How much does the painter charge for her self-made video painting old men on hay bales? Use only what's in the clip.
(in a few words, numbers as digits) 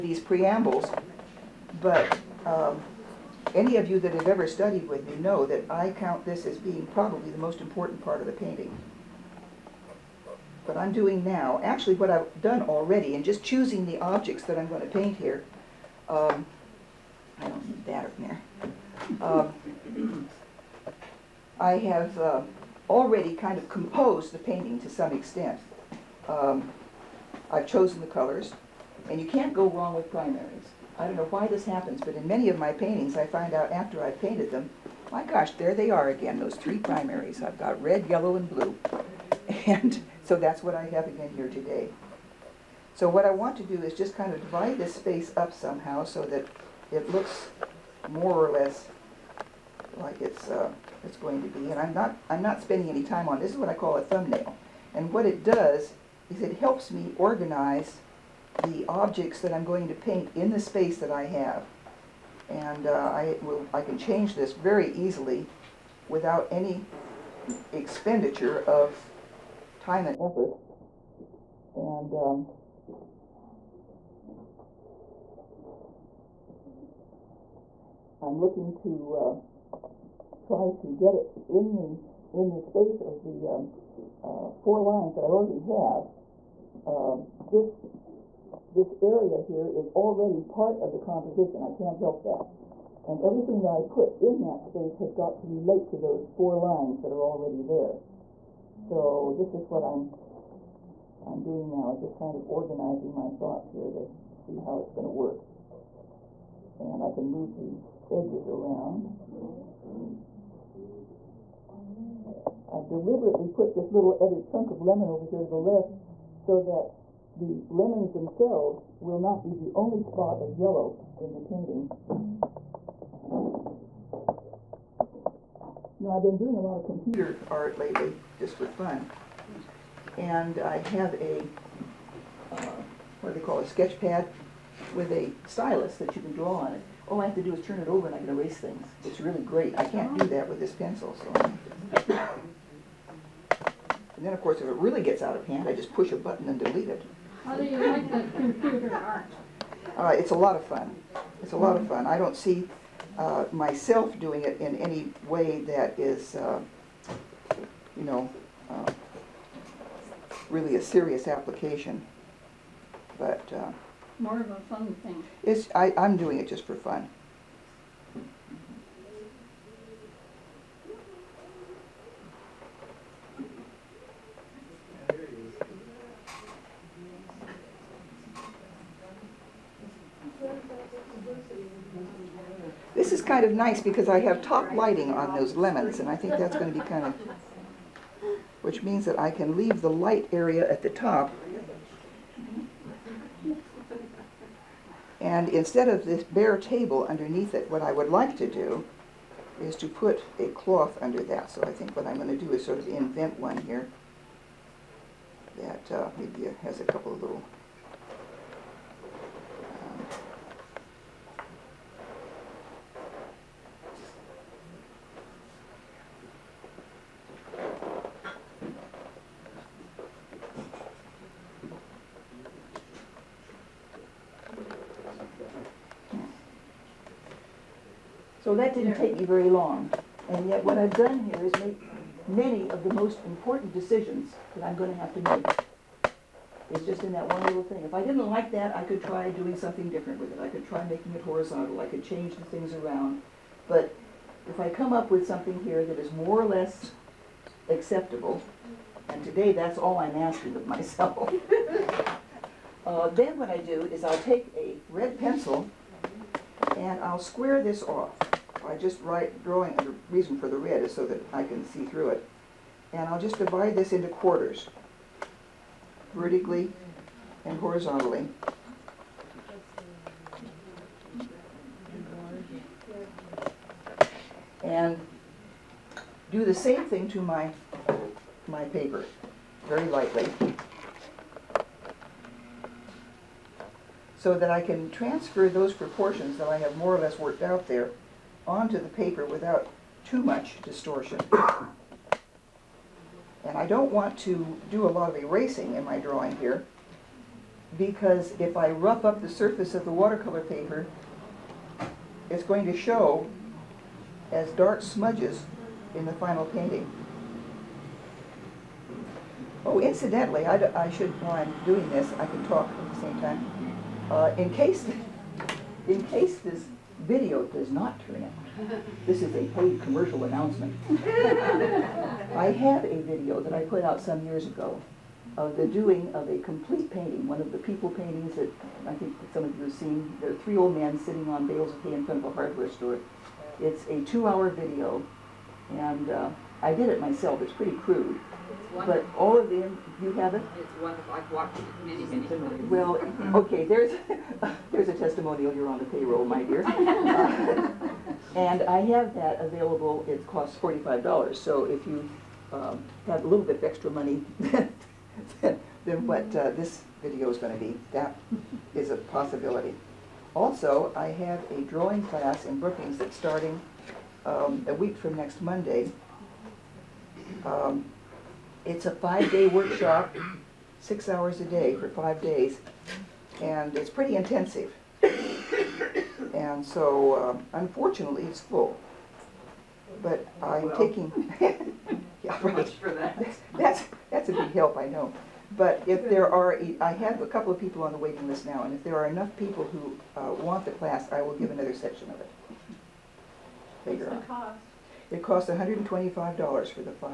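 $45.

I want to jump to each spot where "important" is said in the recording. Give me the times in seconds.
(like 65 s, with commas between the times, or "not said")
7 s, 233 s.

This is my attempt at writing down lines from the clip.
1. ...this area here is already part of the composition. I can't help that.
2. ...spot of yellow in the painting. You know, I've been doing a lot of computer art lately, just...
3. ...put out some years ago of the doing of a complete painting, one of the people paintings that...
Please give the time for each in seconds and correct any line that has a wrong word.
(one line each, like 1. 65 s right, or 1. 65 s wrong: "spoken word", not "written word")
1. 88 s right
2. 120 s right
3. 323 s right.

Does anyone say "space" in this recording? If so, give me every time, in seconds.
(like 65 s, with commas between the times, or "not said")
44 s, 60 s, 82 s, 94 s.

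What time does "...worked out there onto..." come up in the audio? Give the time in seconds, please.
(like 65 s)
287 s.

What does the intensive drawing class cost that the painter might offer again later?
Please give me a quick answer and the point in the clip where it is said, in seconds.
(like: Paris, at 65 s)
$125, at 395 s.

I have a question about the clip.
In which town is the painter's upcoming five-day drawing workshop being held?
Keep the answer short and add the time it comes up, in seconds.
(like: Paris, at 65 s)
Brookings, at 362 s.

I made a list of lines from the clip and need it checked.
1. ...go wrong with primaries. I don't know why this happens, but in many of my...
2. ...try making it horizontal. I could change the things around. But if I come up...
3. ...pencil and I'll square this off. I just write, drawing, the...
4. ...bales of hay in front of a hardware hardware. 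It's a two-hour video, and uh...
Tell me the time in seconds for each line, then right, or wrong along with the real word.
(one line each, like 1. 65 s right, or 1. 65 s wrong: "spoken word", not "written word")
1. 29 s right
2. 240 s right
3. 255 s right
4. 331 s wrong: "store", not "hardware".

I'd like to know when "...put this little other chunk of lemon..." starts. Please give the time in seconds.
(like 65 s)
113 s.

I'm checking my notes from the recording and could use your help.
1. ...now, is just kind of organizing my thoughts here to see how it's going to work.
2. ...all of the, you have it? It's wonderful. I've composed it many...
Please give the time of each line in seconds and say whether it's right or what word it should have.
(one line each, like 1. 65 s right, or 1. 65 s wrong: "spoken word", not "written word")
1. 101 s right
2. 339 s wrong: "watched", not "composed".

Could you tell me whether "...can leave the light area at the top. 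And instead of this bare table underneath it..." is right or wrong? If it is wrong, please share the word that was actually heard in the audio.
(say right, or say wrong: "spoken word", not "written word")
right.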